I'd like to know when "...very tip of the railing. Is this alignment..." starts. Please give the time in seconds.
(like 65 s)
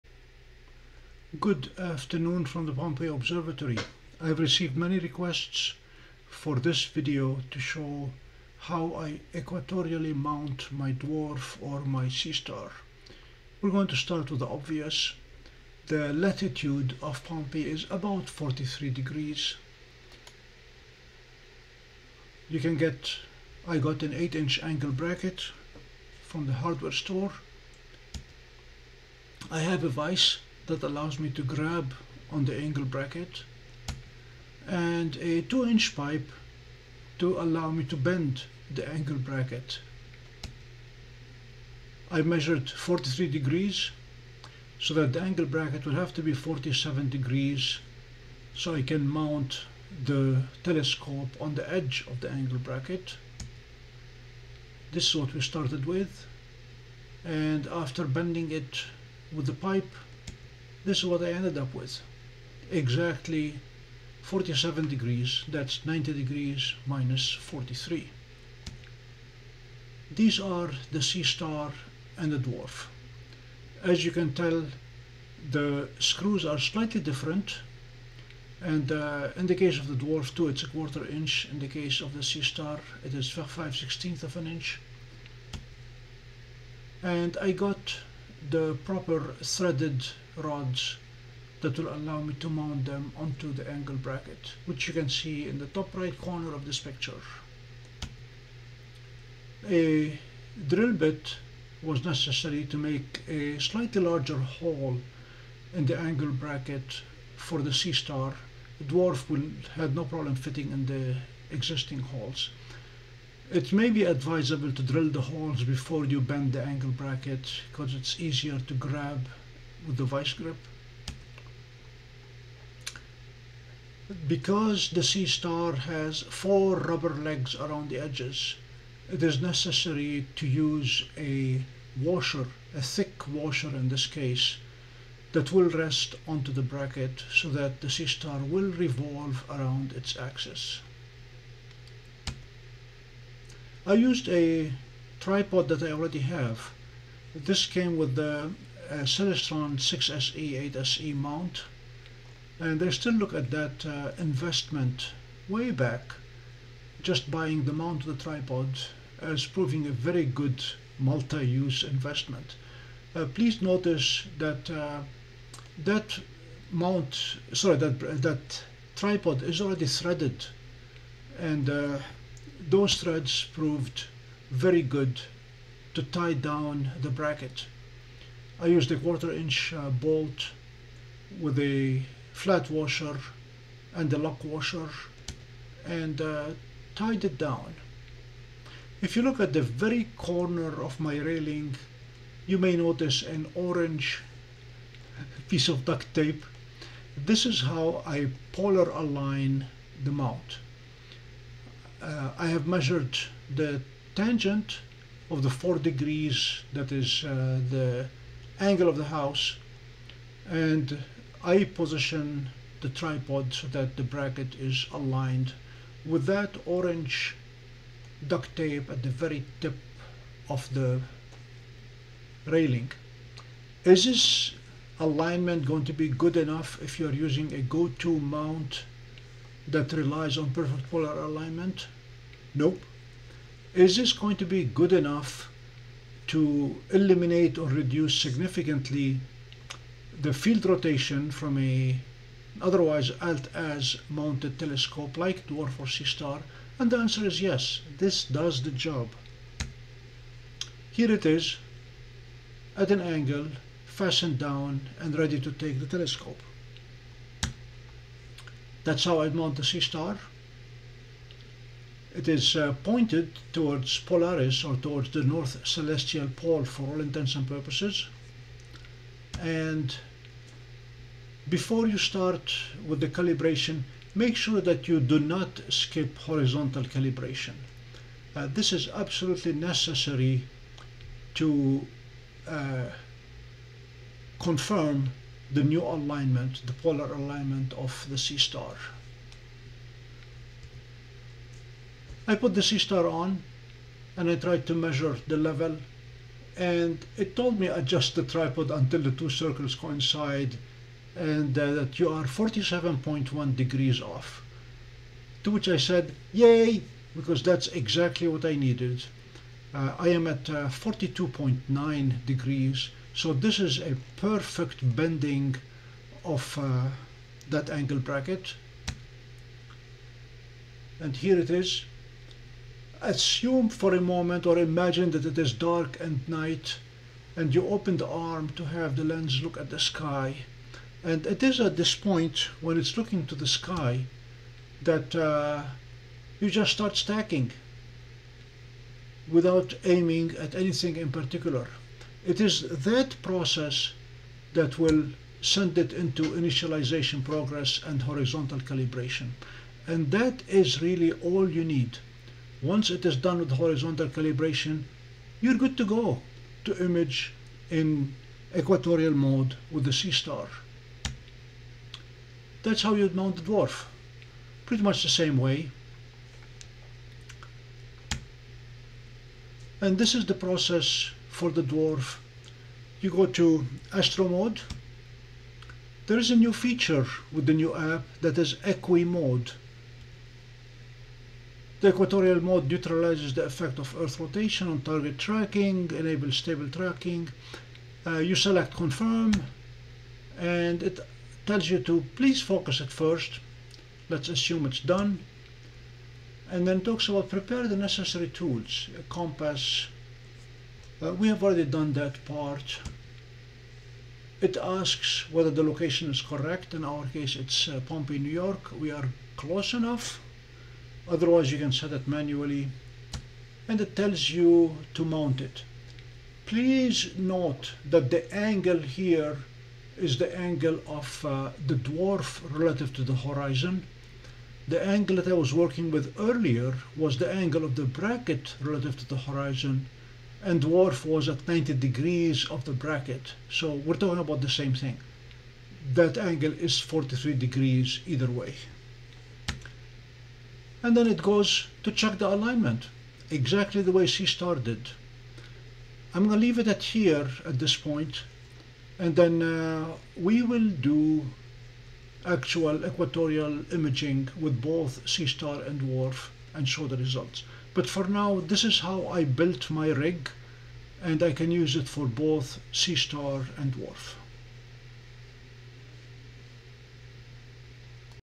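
219 s.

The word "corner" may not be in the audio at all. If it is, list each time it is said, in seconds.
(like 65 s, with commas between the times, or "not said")
96 s, 190 s.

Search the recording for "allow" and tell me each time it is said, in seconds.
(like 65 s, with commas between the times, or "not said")
30 s, 37 s, 91 s.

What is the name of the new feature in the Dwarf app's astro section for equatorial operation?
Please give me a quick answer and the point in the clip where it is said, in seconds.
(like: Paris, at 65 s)
Equi Mode, at 378 s.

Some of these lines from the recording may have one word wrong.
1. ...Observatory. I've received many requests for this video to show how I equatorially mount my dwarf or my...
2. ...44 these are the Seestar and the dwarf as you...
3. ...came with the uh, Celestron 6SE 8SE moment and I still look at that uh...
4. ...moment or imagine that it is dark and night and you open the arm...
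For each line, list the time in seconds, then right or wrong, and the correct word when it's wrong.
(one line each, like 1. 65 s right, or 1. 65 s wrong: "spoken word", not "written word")
1. 3 s right
2. 67 s wrong: "43", not "44"
3. 147 s wrong: "mount", not "moment"
4. 323 s right.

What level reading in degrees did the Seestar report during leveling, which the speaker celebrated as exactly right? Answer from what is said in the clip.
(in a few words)
47.1 degrees.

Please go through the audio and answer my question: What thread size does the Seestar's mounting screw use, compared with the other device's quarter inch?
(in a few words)
5/16 of an inch.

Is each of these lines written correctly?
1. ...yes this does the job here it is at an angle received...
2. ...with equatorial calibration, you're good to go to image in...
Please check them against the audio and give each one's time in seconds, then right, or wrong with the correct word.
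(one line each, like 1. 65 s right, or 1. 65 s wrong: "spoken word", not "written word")
1. 247 s wrong: "fastened", not "received"
2. 353 s wrong: "horizontal", not "equatorial".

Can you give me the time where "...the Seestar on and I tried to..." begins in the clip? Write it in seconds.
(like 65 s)
292 s.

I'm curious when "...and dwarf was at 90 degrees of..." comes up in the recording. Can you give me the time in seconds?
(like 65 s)
430 s.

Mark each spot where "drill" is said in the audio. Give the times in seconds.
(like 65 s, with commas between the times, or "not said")
100 s, 114 s.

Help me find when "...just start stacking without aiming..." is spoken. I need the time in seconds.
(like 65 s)
336 s.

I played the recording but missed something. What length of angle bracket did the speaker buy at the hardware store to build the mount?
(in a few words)
8 inch.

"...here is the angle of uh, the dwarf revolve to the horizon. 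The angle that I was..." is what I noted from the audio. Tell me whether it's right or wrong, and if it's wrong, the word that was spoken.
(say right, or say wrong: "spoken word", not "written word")
wrong: "relative", not "revolve".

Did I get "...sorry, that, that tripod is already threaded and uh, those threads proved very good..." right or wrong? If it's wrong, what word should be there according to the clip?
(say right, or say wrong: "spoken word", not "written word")
right.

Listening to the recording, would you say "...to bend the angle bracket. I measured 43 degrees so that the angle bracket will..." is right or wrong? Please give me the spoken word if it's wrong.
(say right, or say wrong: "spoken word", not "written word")
right.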